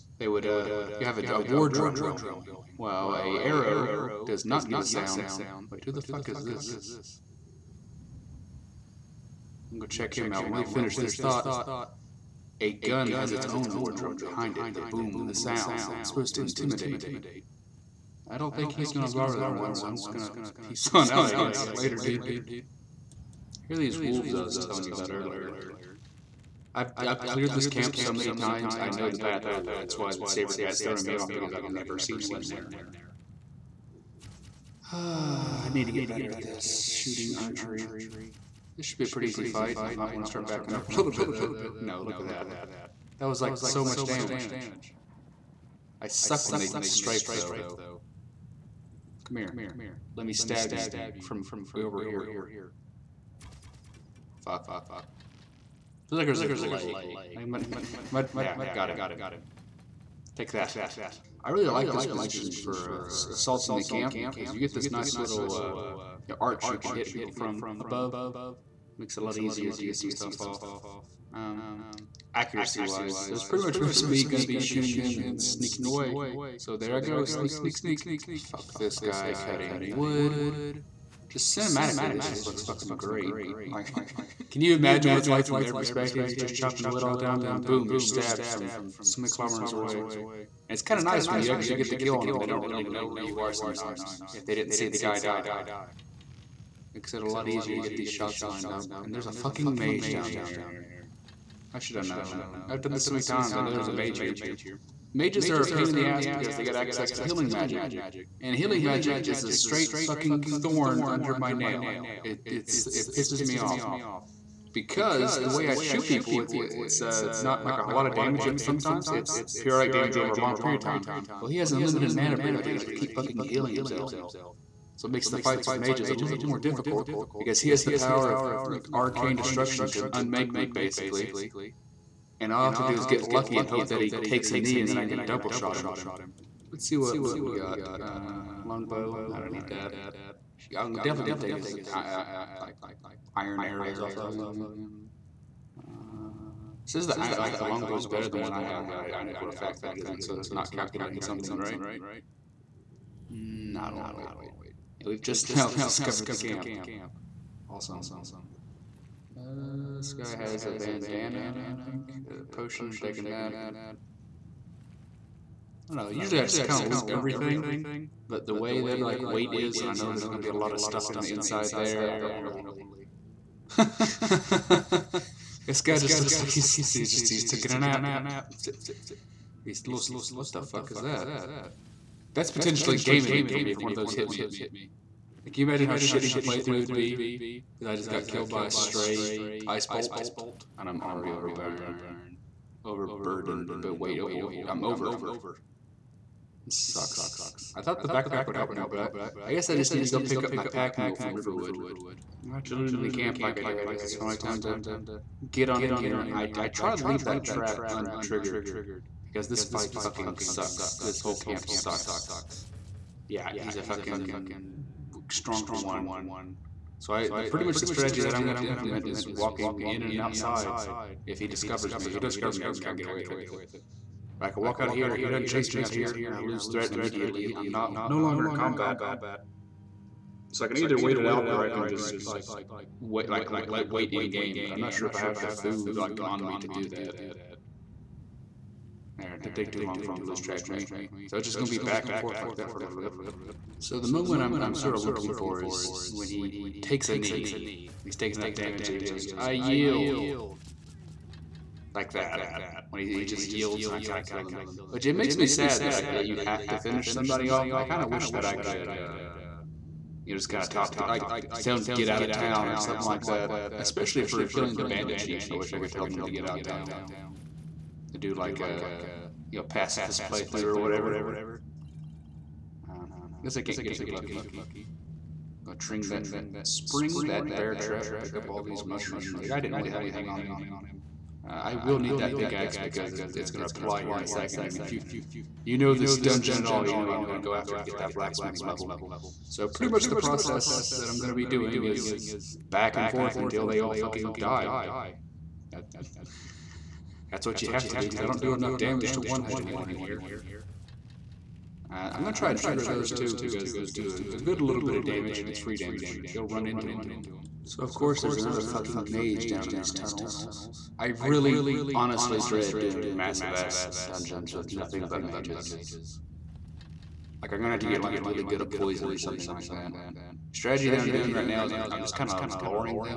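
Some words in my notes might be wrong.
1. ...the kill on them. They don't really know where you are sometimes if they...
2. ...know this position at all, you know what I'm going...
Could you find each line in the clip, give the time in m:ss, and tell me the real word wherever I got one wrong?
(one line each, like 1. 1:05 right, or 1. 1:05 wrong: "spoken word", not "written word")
1. 1:31 right
2. 4:45 wrong: "dungeon", not "position".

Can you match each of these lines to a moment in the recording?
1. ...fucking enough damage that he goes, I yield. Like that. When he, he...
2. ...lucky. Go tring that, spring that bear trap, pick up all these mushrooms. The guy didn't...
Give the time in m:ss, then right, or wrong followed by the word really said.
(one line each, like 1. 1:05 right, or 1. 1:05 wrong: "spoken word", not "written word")
1. 4:08 wrong: "taking", not "fucking"
2. 4:34 right.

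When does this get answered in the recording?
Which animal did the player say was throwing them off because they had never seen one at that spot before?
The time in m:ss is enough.
0:30.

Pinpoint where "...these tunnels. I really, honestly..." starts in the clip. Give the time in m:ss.
5:09.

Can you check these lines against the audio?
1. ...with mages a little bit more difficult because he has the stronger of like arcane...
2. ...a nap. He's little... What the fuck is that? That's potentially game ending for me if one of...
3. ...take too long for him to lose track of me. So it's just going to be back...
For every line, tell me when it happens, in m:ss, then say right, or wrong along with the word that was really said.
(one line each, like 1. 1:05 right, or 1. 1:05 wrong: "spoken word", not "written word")
1. 2:05 wrong: "power", not "stronger"
2. 2:57 right
3. 3:59 right.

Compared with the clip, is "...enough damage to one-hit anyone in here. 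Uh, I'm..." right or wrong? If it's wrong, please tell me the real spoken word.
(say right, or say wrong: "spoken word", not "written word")
right.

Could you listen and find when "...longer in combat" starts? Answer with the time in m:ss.
3:48.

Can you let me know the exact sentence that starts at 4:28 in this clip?
To do like a you know, pacifist playthrough or whatever.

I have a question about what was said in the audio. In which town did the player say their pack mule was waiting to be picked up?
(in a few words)
Riverwood.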